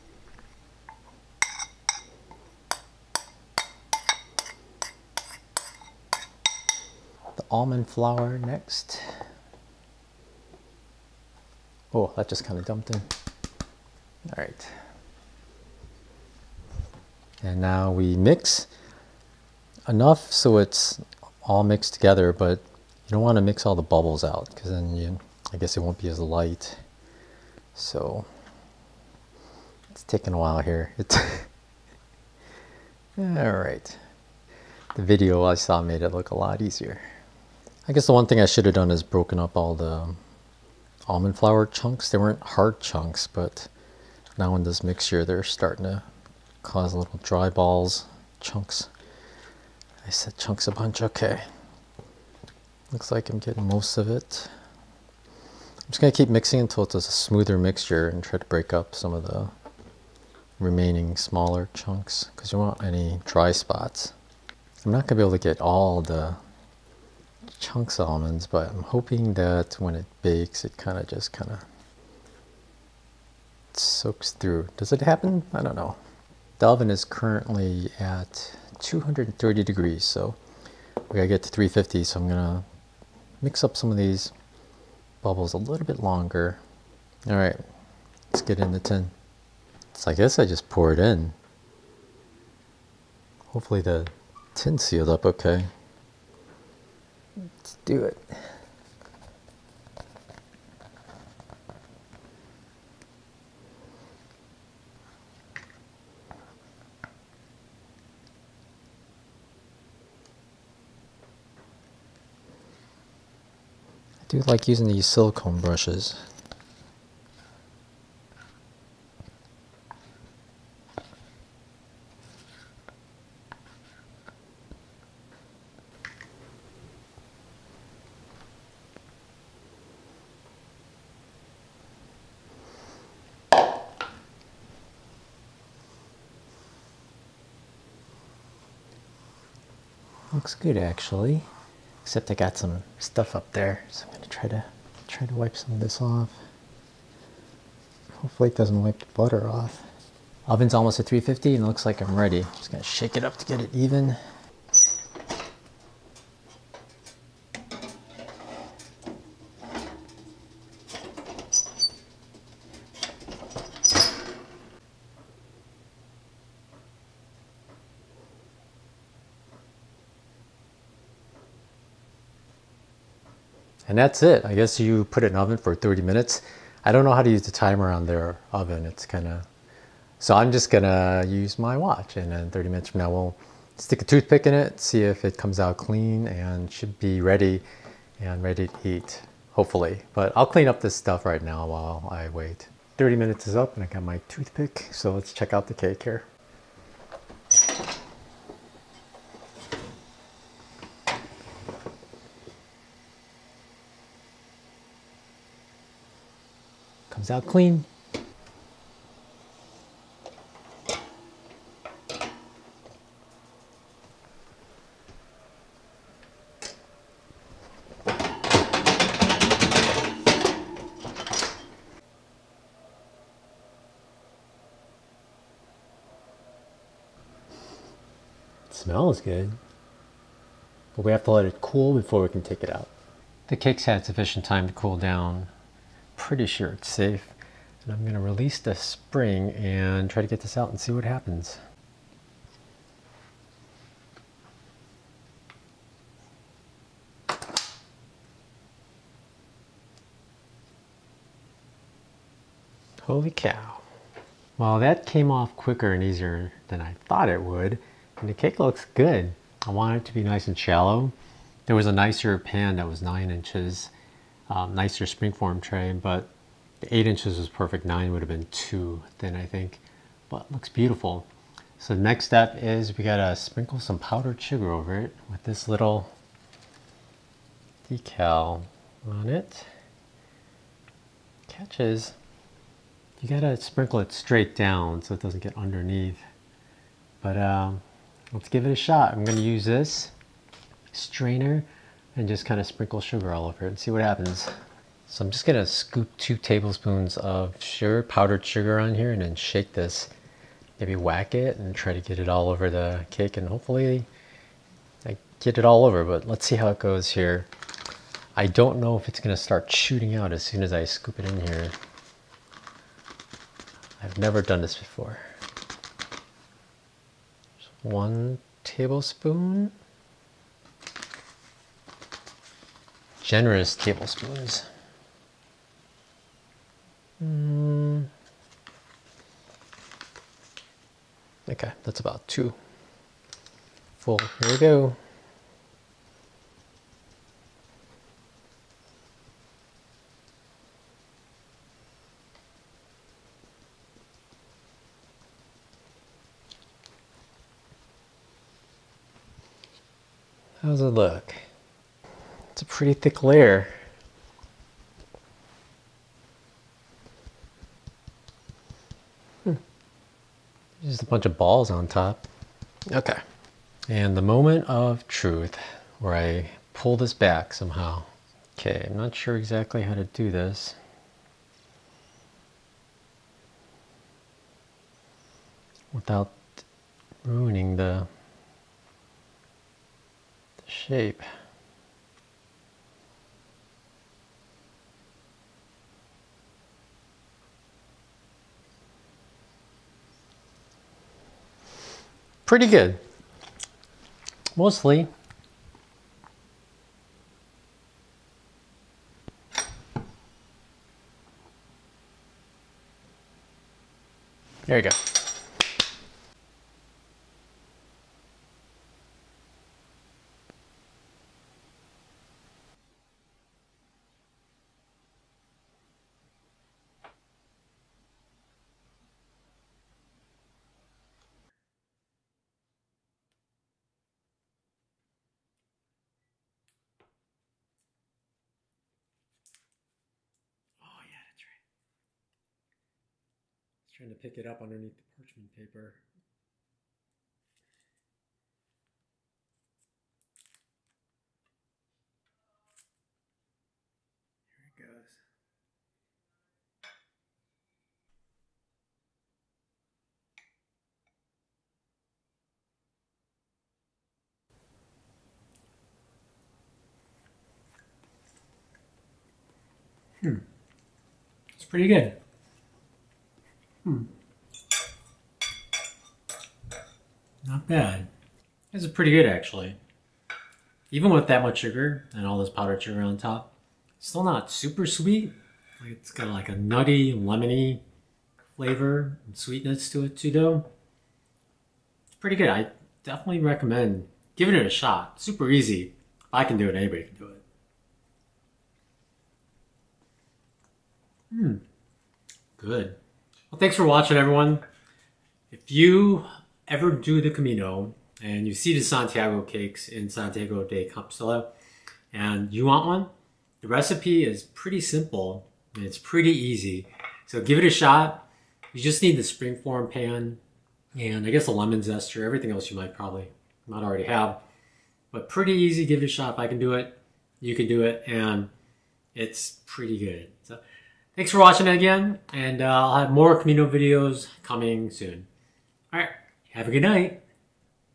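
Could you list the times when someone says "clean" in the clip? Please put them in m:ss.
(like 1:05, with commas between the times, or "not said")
3:05, 3:10, 3:27.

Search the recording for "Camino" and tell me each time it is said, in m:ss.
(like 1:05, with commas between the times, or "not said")
8:17, 8:43.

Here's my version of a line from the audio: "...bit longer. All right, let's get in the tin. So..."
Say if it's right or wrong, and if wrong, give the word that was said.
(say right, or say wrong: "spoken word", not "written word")
right.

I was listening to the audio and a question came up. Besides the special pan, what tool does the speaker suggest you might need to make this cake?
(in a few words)
lemon zester.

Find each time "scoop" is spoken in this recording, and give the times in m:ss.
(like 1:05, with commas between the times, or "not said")
4:55, 5:10.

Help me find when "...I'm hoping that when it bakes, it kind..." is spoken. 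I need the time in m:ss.
1:08.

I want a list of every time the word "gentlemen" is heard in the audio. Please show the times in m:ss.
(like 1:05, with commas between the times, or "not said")
not said.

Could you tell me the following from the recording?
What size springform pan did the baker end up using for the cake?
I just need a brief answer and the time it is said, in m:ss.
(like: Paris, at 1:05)
8 inches, at 4:26.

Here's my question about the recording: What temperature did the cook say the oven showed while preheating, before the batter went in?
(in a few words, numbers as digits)
230 degrees.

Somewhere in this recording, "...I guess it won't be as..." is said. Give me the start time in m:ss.
0:25.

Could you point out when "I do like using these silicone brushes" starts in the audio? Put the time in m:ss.
1:53.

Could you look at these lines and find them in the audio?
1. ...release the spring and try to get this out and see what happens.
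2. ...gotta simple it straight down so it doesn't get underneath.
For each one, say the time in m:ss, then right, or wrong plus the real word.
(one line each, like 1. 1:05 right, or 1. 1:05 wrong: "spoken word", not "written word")
1. 3:58 right
2. 4:43 wrong: "sprinkle", not "simple".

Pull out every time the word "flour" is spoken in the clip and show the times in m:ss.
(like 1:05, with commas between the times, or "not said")
0:07, 0:41.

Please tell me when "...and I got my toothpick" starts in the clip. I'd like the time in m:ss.
3:13.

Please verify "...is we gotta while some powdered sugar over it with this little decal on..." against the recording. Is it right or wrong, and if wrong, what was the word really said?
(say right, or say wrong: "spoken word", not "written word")
wrong: "sprinkle", not "while".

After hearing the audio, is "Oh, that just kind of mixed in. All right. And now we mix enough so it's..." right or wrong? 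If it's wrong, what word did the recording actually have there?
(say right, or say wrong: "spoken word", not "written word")
wrong: "dumped", not "mixed".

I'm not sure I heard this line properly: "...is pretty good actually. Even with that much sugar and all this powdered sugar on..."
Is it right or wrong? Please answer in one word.
right.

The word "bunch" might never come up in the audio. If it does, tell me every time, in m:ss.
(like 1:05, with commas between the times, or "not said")
0:50, 6:01.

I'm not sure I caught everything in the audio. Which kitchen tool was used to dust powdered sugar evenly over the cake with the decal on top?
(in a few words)
strainer.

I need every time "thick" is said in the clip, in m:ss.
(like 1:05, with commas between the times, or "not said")
5:52.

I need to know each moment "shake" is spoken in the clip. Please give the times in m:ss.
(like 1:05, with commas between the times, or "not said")
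2:32, 4:59.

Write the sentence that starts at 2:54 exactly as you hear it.
I guess you put it in oven for 30 minutes.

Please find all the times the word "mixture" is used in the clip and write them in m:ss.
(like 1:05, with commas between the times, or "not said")
0:44, 0:57.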